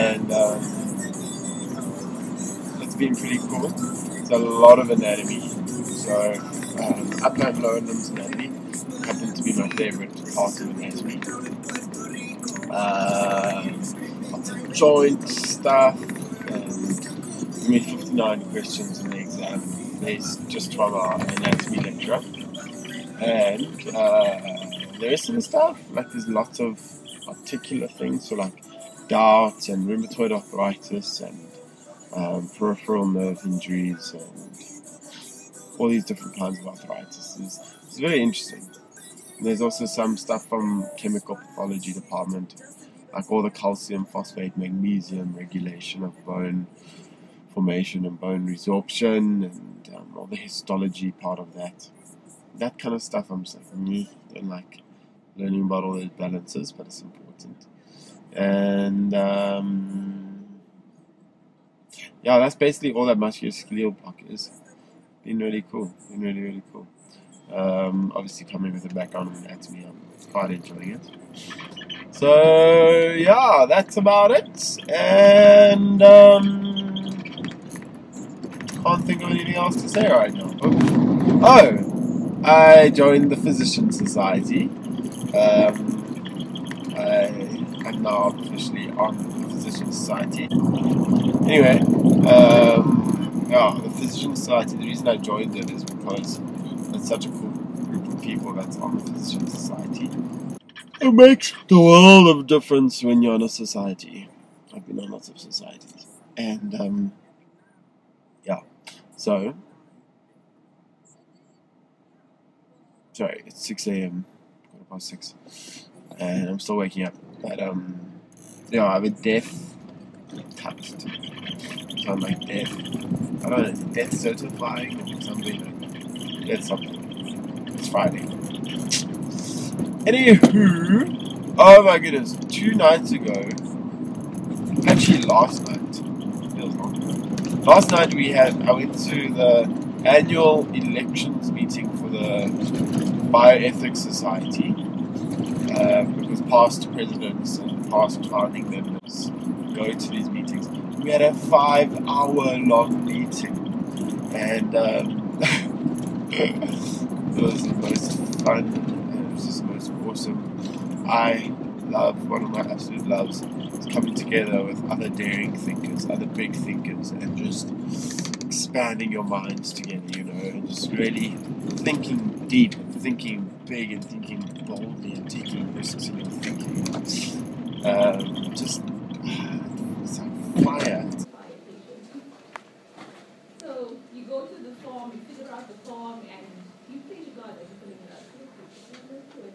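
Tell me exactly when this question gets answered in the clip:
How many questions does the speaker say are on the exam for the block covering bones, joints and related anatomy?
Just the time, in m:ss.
0:17.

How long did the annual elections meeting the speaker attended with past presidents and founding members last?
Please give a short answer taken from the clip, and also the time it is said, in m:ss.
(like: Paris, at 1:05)
5 hours, at 2:31.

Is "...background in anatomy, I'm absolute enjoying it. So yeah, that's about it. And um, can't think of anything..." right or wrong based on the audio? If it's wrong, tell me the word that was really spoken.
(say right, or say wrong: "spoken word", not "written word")
wrong: "quite", not "absolute".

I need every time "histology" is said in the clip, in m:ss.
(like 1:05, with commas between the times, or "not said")
0:50.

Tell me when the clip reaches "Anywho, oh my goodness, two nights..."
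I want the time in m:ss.
2:10.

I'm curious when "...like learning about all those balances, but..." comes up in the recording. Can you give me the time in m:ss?
0:54.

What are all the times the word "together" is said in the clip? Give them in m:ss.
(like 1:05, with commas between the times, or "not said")
2:44, 2:49.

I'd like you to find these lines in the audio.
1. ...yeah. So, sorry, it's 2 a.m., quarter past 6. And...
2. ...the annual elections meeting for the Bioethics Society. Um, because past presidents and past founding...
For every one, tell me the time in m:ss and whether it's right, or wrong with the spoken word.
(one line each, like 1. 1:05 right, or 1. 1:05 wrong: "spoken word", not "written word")
1. 1:48 wrong: "6", not "2"
2. 2:19 right.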